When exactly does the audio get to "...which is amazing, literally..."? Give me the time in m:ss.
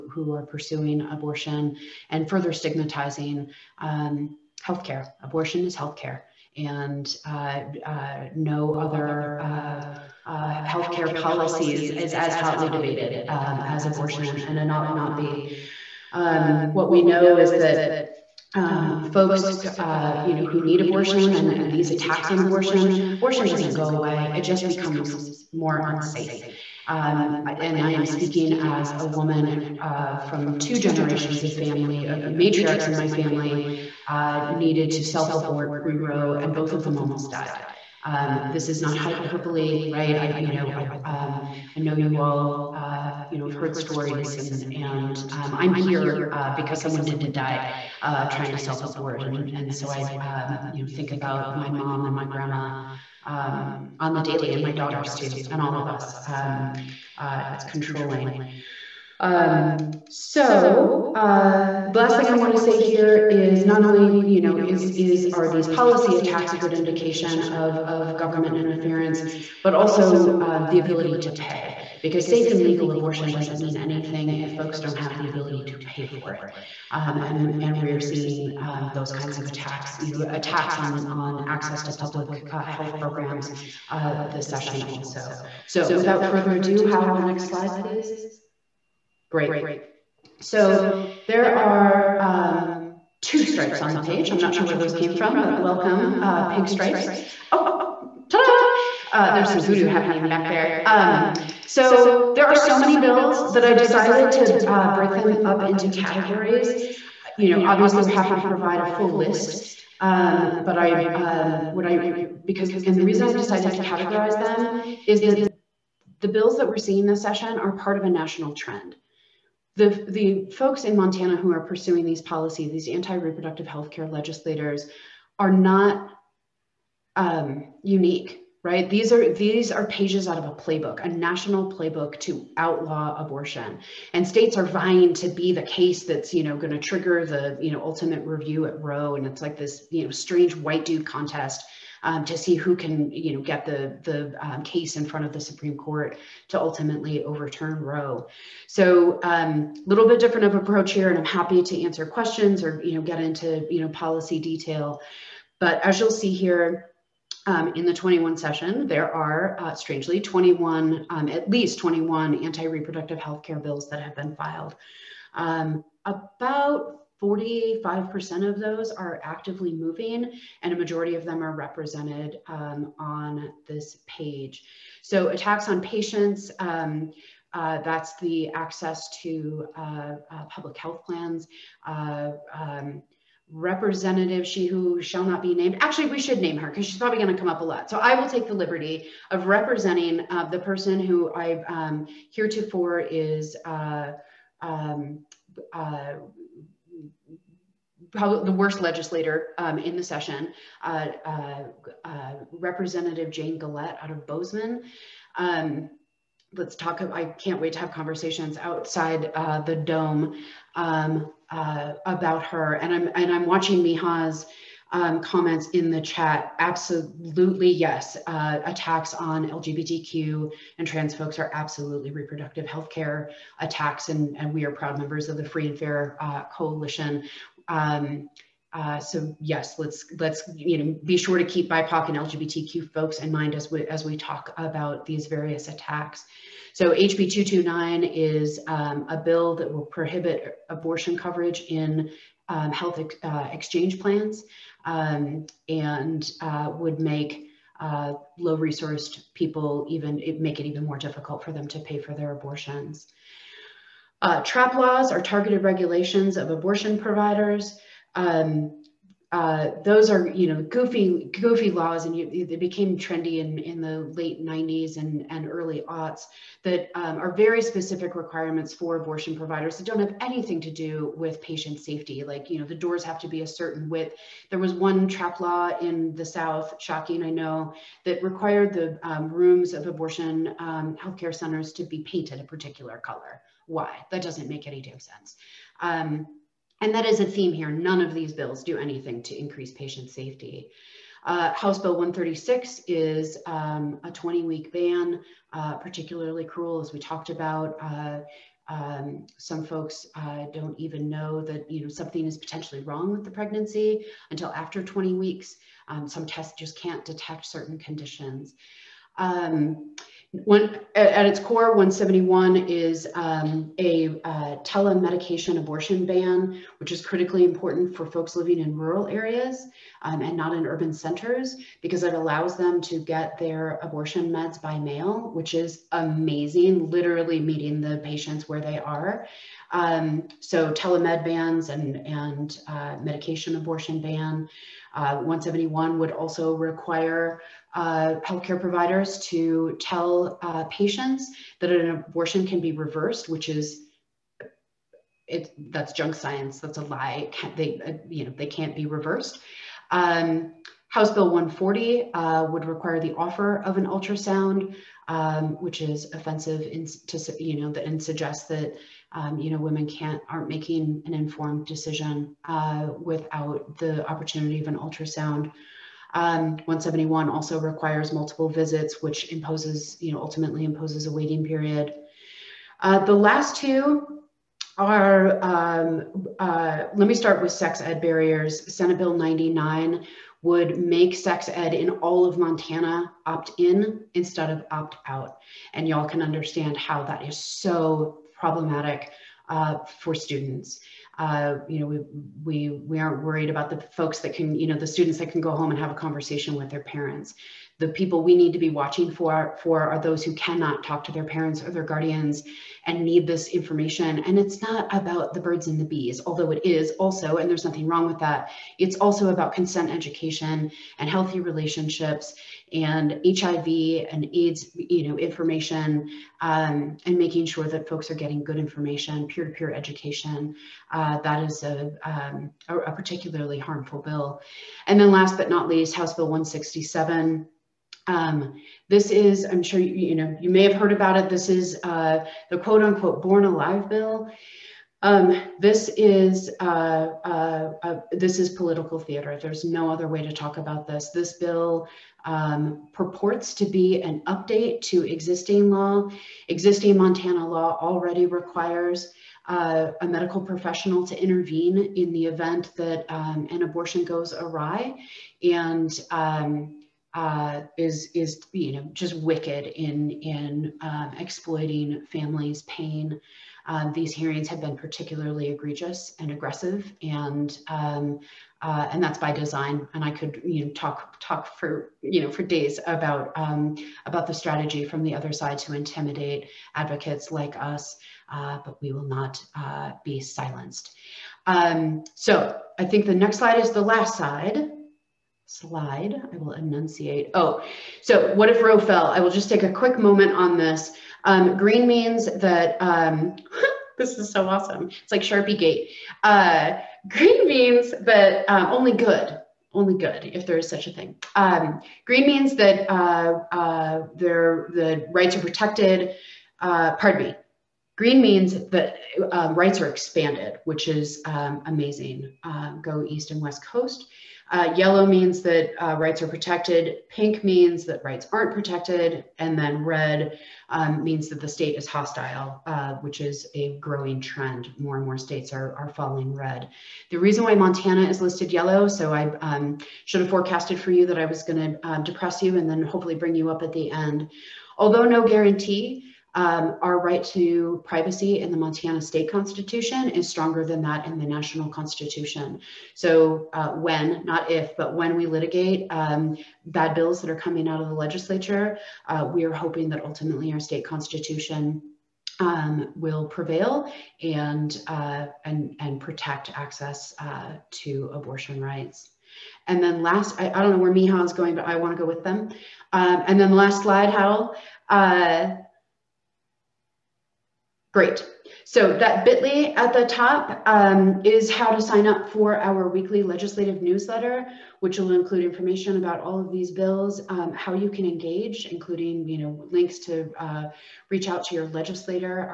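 5:25.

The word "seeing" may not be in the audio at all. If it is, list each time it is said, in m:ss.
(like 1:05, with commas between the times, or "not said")
1:17, 1:56.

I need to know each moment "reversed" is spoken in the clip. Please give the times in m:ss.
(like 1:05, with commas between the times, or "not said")
5:42, 5:48.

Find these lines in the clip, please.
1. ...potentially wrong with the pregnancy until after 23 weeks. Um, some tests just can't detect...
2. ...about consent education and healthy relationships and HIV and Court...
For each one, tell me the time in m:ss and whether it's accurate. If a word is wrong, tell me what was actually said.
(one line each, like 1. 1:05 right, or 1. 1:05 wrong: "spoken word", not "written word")
1. 5:02 wrong: "20", not "23"
2. 6:49 wrong: "AIDS", not "Court".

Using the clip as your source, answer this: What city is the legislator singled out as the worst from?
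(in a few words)
Bozeman.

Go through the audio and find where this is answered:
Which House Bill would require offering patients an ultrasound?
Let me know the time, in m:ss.
5:50.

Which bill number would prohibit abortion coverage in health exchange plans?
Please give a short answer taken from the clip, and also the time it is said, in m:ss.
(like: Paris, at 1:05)
HB 229, at 3:56.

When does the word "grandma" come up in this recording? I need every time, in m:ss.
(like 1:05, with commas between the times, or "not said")
0:52.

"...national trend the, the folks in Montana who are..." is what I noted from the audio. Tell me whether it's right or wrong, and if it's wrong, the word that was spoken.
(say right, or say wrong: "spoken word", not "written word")
right.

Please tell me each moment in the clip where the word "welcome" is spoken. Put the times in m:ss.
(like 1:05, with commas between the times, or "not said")
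1:35.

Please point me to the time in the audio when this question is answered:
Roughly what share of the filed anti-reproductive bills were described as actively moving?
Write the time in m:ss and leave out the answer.
2:47.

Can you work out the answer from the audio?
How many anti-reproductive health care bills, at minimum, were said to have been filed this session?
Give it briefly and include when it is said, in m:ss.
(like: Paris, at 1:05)
21, at 2:41.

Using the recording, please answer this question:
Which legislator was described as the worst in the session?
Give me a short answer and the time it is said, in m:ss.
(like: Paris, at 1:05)
Jane Gillette, at 3:23.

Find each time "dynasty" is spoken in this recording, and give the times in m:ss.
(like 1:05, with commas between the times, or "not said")
not said.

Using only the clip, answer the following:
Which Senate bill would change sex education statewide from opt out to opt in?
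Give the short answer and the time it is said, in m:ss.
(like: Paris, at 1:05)
Senate Bill 99, at 6:18.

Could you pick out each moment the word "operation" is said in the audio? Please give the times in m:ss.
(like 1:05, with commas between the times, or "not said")
not said.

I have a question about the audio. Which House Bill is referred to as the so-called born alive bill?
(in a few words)
House Bill 167.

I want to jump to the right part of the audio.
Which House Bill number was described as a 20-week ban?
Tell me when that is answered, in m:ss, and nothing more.
4:51.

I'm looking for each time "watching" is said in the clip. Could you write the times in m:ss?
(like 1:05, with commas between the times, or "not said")
3:33, 6:38.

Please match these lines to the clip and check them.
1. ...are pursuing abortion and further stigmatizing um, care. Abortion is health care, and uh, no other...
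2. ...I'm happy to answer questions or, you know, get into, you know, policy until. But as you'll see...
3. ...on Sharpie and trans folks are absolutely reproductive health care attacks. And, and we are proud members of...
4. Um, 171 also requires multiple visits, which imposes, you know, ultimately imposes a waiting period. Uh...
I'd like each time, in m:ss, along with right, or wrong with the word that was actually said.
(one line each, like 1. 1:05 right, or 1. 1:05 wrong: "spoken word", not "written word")
1. 0:00 right
2. 2:31 wrong: "detail", not "until"
3. 3:39 wrong: "LGBTQ", not "Sharpie"
4. 6:06 right.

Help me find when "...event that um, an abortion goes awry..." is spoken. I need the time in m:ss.
7:32.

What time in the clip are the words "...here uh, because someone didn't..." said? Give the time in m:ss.
0:45.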